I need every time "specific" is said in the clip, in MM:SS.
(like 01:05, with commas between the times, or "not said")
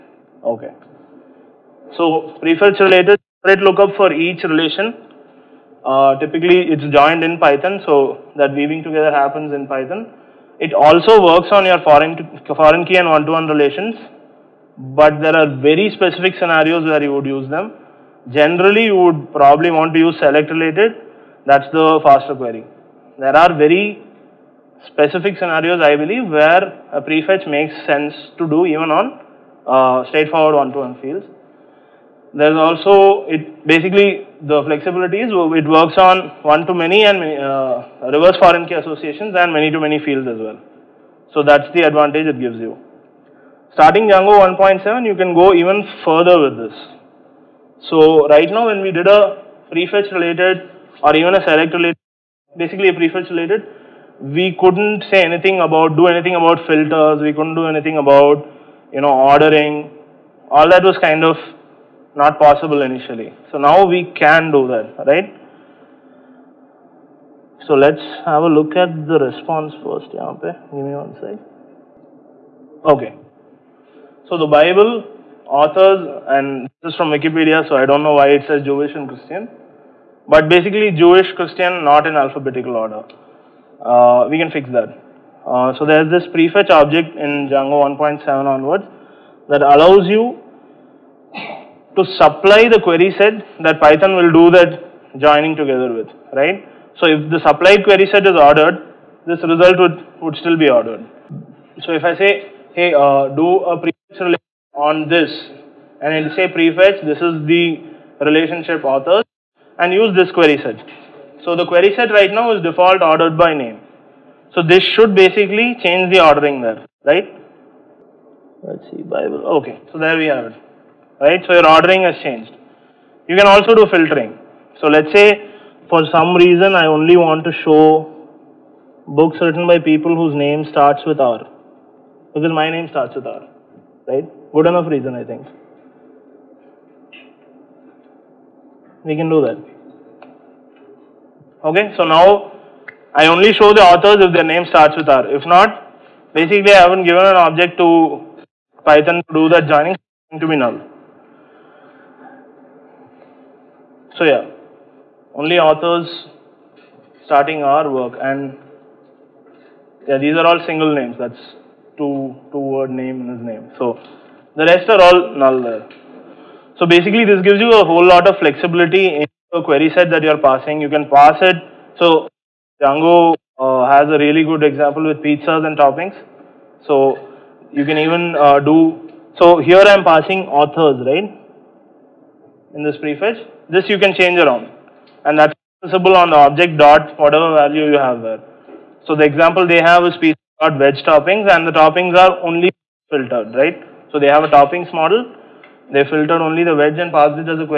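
00:15, 00:24.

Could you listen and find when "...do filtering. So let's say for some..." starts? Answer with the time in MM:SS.
02:03.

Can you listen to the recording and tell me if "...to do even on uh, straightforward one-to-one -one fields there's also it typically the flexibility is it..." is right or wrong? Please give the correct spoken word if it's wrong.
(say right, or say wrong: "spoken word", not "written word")
wrong: "basically", not "typically".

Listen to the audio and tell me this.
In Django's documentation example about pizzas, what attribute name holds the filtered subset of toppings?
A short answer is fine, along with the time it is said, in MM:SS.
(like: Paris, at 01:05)
veg toppings, at 03:10.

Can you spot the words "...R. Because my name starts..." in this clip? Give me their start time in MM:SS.
02:11.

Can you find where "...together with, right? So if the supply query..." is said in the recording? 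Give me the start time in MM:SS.
01:35.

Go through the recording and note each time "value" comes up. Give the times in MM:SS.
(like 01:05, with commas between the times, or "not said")
03:07.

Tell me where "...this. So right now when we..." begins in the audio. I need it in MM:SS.
00:46.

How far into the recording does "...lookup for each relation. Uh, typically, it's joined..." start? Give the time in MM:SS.
00:03.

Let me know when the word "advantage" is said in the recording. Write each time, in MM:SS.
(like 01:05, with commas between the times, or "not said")
00:41.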